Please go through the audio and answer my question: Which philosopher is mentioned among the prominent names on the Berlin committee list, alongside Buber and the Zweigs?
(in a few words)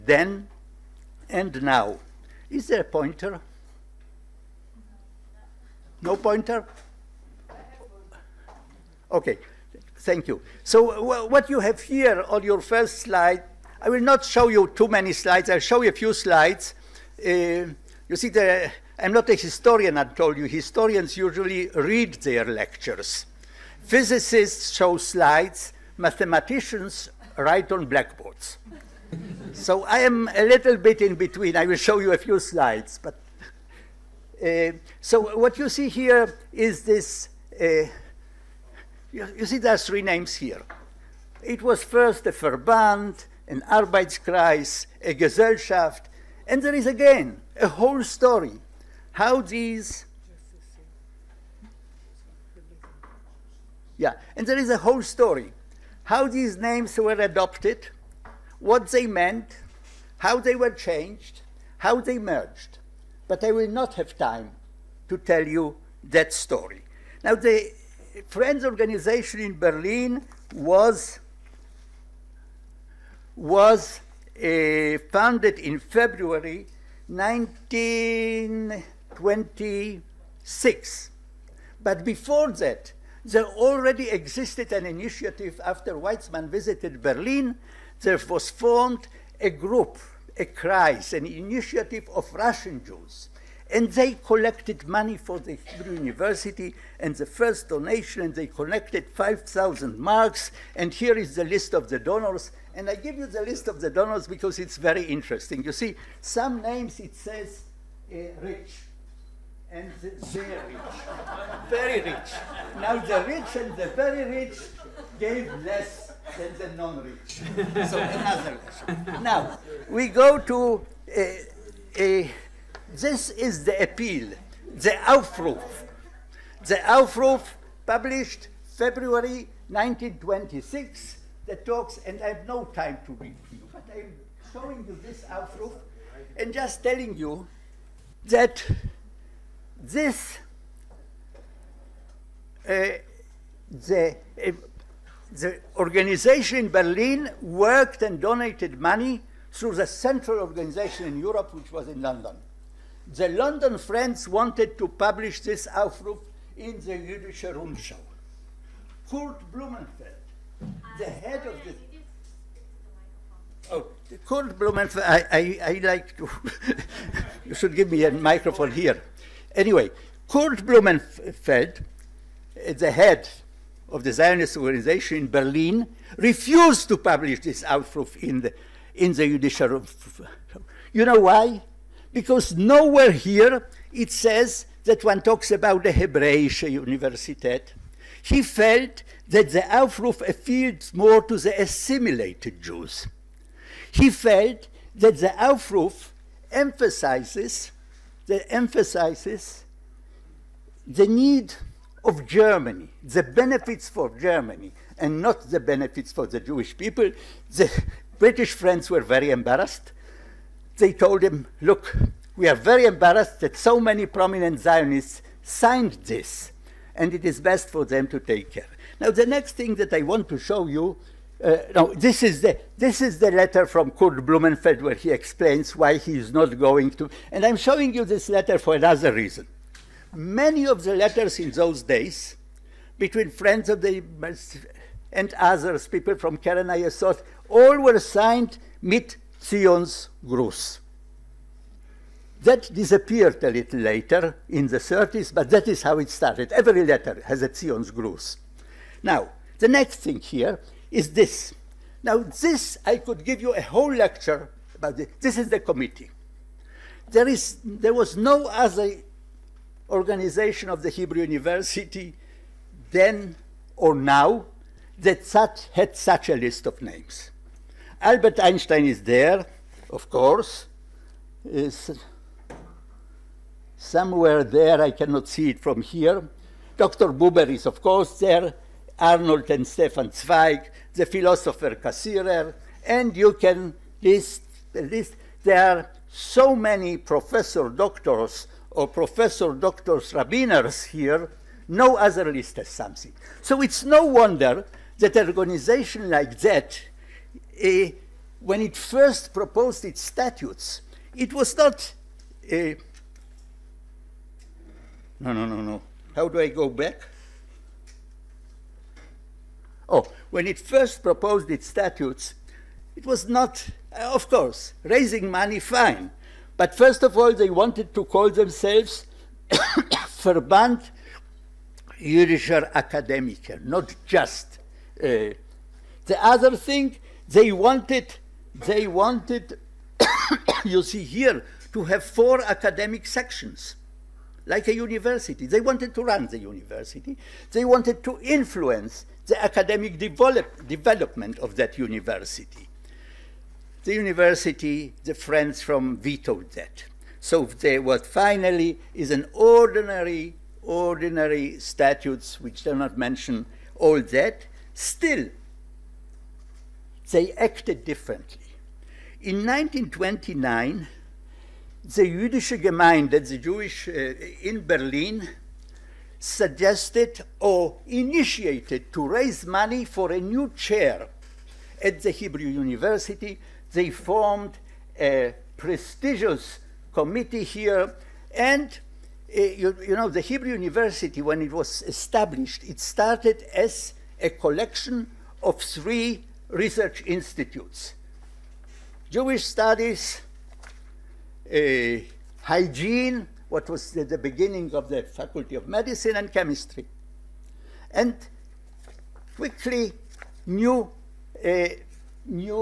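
Cassirer.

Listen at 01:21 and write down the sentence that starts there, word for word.
But before that, there already existed an initiative after Weizmann visited Berlin.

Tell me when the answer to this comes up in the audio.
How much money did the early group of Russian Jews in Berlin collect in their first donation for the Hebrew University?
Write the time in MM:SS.
01:39.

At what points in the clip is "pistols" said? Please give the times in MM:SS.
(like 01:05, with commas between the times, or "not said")
not said.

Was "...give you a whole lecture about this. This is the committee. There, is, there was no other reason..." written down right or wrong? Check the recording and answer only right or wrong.
wrong.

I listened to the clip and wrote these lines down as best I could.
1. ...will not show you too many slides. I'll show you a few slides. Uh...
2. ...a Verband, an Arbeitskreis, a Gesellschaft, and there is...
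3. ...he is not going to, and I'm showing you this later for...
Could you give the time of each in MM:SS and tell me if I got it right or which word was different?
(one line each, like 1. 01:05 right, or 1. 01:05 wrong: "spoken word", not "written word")
1. 00:13 right
2. 00:42 right
3. 03:45 wrong: "letter", not "later".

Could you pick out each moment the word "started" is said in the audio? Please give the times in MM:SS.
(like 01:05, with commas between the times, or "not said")
04:06, 06:22.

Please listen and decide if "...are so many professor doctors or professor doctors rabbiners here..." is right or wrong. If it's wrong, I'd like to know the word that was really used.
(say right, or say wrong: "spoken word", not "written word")
right.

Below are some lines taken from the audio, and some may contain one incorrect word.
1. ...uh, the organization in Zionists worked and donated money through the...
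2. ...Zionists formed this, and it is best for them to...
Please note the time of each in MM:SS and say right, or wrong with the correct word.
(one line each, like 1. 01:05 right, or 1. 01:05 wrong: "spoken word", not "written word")
1. 02:24 wrong: "Berlin", not "Zionists"
2. 03:34 wrong: "signed", not "formed".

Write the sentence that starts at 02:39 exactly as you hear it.
Kurt Blumenfeld, the head of the...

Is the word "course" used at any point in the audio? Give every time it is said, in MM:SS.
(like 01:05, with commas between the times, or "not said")
04:30, 04:37, 05:14.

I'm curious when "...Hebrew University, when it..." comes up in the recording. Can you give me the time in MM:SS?
06:20.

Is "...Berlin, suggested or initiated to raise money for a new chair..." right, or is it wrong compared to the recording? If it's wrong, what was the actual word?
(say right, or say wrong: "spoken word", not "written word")
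right.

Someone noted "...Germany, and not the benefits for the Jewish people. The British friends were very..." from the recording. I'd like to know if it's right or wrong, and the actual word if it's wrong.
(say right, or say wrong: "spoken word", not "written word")
right.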